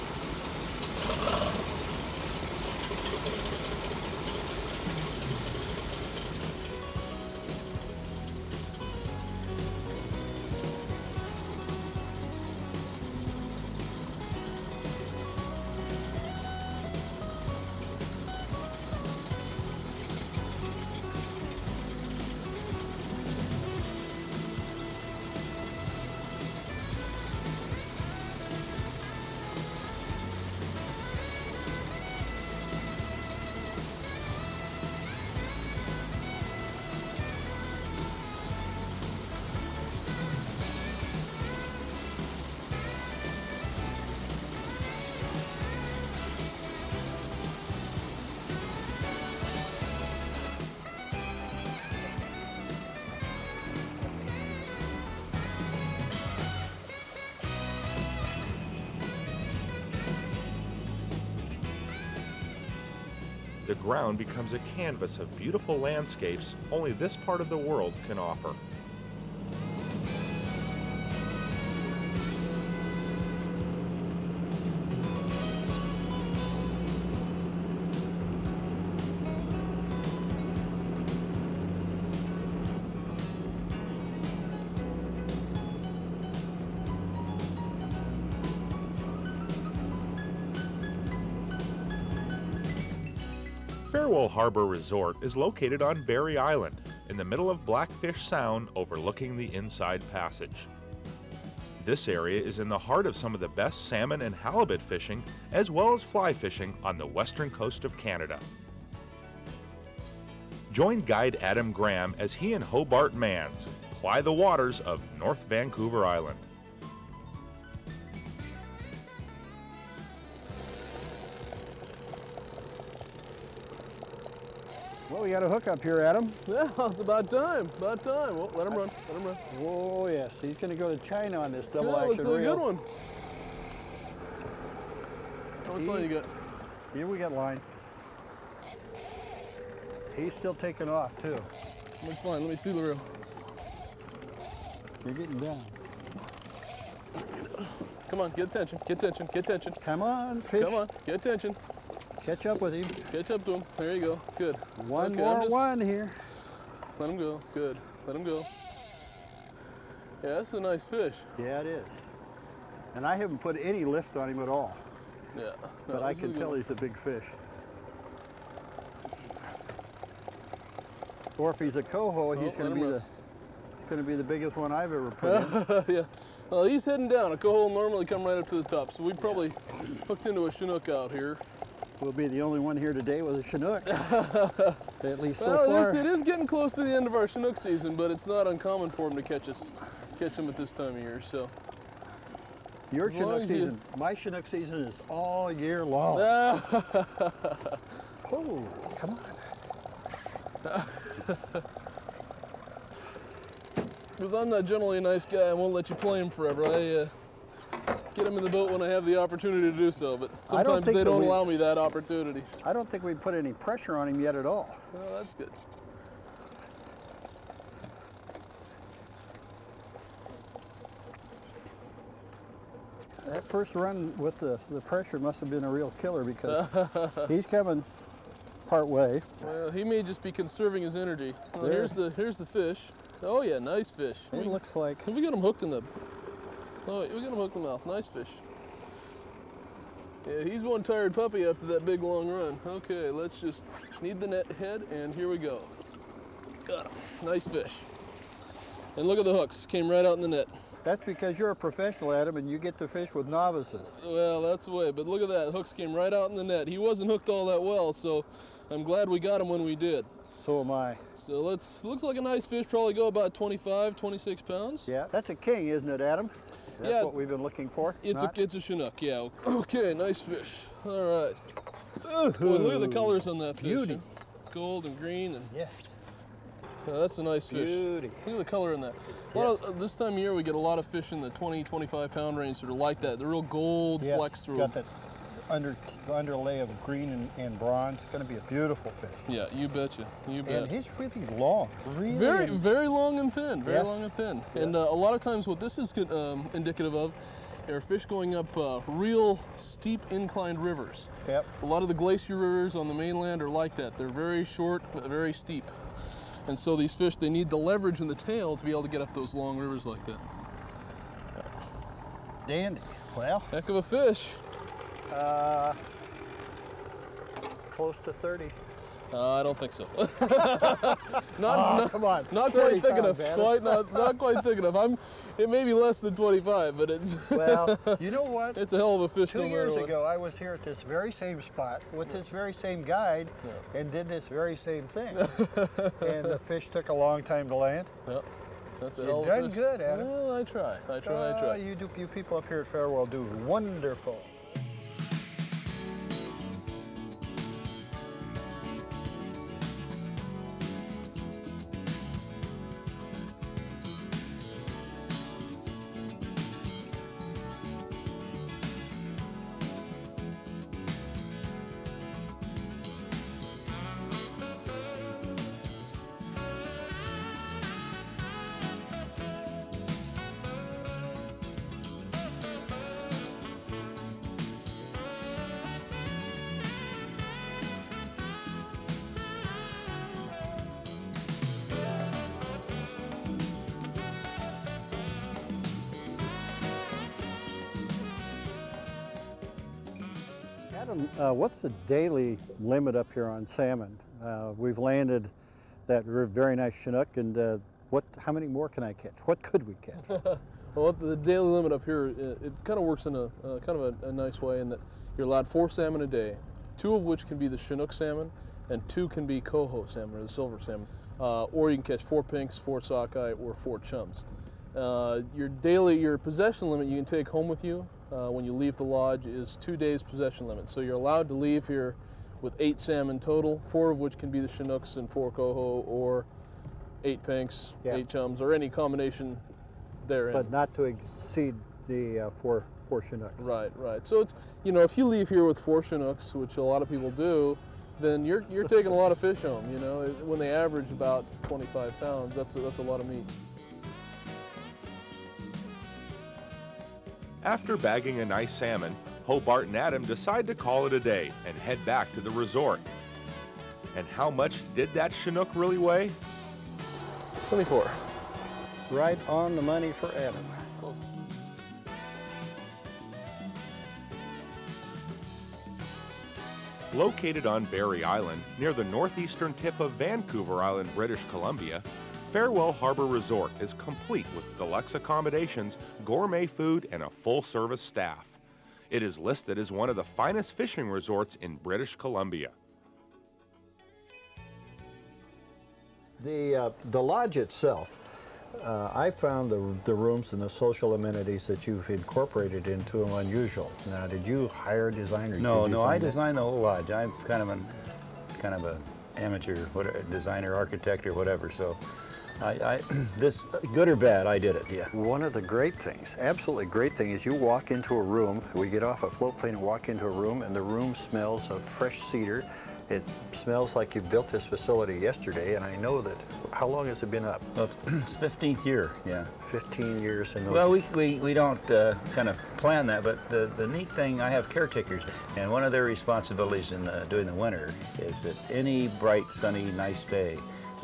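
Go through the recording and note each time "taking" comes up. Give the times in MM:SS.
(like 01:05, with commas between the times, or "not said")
02:20, 07:18.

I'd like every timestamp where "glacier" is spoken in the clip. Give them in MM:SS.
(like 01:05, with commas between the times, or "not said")
05:01.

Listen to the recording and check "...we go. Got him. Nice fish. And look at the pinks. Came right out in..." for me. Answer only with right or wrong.
wrong.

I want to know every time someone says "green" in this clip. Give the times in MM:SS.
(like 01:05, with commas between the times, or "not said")
04:34, 04:46.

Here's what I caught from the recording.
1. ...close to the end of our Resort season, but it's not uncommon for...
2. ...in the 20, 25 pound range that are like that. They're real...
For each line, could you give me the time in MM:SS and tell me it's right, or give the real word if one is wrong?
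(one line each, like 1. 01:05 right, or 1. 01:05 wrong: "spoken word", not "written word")
1. 03:06 wrong: "Chinook", not "Resort"
2. 04:41 right.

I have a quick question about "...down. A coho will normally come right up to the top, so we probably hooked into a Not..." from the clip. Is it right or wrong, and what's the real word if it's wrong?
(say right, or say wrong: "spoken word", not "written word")
wrong: "Chinook", not "Not".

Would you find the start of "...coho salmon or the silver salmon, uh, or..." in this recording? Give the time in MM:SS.
06:49.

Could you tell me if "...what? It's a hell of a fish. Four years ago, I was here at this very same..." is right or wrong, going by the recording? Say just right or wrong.
wrong.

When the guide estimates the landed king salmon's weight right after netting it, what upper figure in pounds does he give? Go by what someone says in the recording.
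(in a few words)
26.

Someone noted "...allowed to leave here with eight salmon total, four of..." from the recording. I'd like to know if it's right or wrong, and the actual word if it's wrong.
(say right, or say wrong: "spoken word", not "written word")
right.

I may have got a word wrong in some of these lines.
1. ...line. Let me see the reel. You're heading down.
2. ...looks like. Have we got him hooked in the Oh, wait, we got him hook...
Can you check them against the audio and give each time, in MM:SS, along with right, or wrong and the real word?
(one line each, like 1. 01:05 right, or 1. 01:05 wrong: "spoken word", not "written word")
1. 02:22 wrong: "getting", not "heading"
2. 03:54 right.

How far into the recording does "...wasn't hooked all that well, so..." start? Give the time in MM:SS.
04:16.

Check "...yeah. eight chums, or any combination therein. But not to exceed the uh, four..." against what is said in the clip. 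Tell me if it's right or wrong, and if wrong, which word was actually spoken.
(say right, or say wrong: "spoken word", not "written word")
right.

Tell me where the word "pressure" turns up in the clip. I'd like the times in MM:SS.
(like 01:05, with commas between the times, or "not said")
03:33, 03:44.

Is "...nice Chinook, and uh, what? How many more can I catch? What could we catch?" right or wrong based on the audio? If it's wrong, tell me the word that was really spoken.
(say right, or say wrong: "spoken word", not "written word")
right.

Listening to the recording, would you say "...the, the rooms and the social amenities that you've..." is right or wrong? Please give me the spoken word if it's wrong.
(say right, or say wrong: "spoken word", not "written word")
right.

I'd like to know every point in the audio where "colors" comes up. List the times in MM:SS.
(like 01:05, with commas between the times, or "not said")
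04:32, 04:38.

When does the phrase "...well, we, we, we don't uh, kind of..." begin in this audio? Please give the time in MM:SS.
08:40.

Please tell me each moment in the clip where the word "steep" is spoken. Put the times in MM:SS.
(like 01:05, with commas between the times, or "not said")
04:59, 05:05.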